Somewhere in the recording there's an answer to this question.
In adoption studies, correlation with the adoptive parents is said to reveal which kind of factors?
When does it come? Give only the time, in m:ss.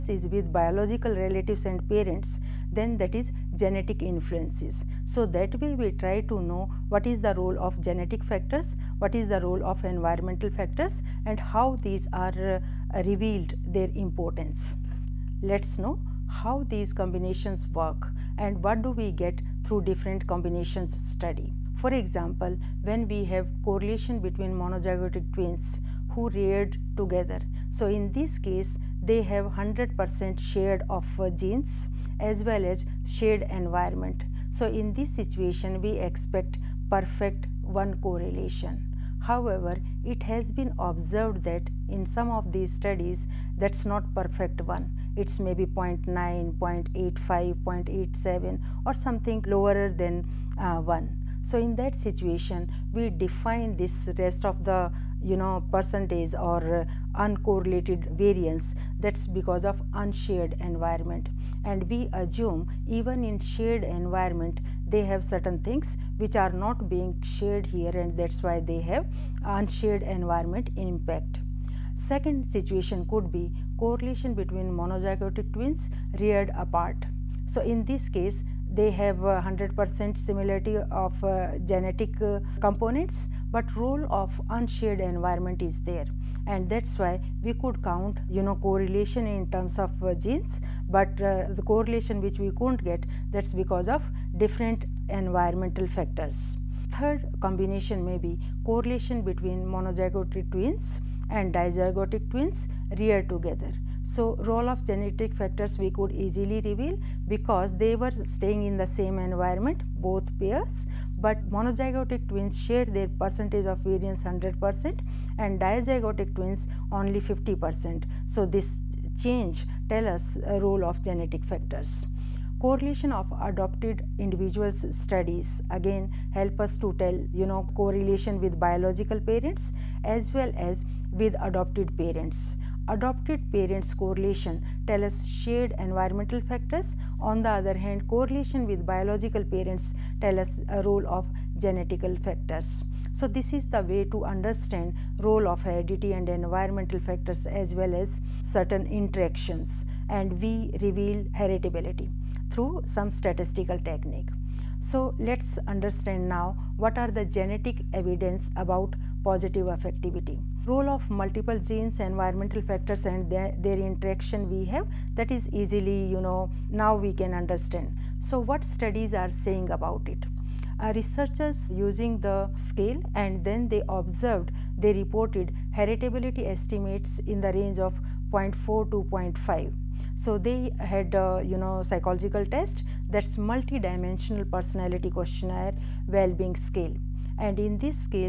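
2:15.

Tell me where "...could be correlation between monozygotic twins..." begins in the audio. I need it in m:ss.
1:13.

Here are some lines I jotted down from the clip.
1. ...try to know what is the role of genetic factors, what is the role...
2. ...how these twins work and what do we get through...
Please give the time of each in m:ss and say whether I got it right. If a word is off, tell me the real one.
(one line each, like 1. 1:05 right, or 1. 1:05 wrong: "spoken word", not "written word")
1. 0:05 right
2. 0:16 wrong: "combinations", not "twins".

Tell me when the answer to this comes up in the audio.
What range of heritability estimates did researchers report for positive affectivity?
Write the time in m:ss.
2:58.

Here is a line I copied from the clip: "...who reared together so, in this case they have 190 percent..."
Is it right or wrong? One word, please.
wrong.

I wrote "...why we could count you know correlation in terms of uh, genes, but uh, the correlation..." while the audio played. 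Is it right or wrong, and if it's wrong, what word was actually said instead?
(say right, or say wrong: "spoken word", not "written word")
right.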